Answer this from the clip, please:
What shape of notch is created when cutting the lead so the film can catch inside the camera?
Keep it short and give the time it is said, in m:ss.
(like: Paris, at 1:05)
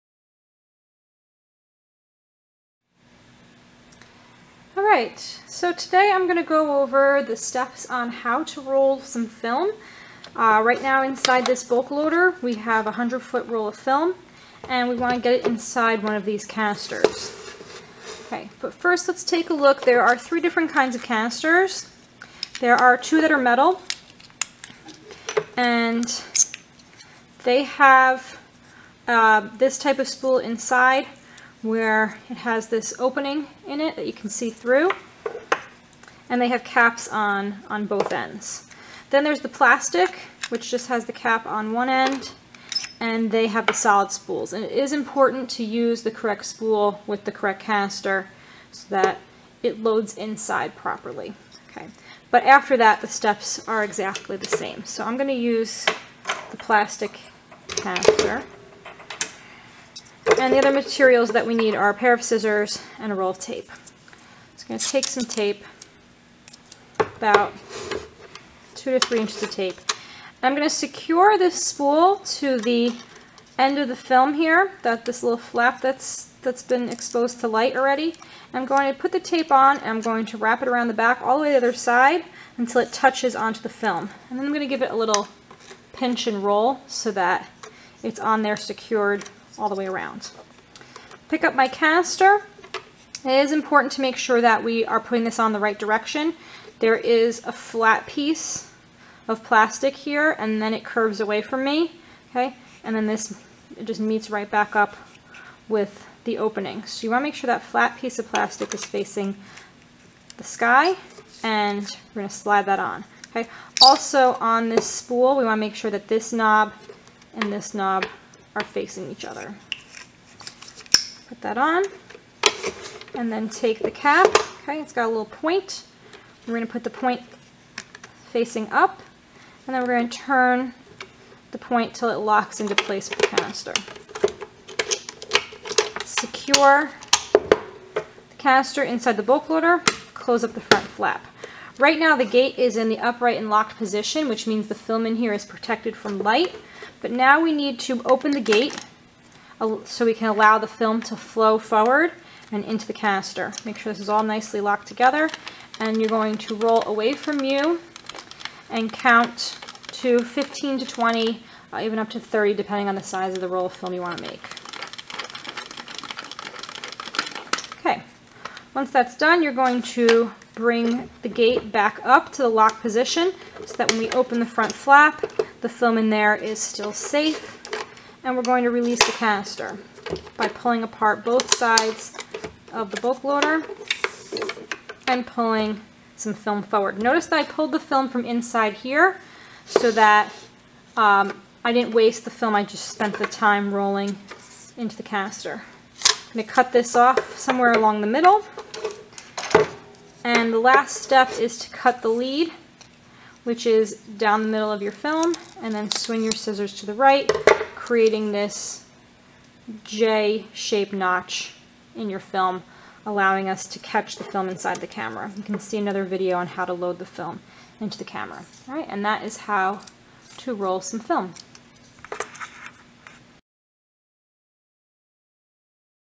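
J-shaped, at 3:29.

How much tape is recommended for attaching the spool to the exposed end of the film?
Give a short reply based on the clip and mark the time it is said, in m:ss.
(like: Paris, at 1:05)
2 to 3 inches, at 1:08.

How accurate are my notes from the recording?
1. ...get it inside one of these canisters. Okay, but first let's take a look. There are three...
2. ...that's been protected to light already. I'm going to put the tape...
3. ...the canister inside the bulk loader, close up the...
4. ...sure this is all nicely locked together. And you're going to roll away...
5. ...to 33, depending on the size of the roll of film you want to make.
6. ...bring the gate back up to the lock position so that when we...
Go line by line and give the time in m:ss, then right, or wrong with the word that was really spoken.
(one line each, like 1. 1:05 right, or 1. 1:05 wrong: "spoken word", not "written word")
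1. 0:15 right
2. 1:16 wrong: "exposed", not "protected"
3. 2:17 right
4. 2:33 right
5. 2:42 wrong: "30", not "33"
6. 2:50 right.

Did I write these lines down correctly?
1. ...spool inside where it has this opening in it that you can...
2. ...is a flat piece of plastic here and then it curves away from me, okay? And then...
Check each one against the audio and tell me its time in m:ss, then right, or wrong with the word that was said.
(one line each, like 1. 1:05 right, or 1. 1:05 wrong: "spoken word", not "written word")
1. 0:30 right
2. 1:36 right.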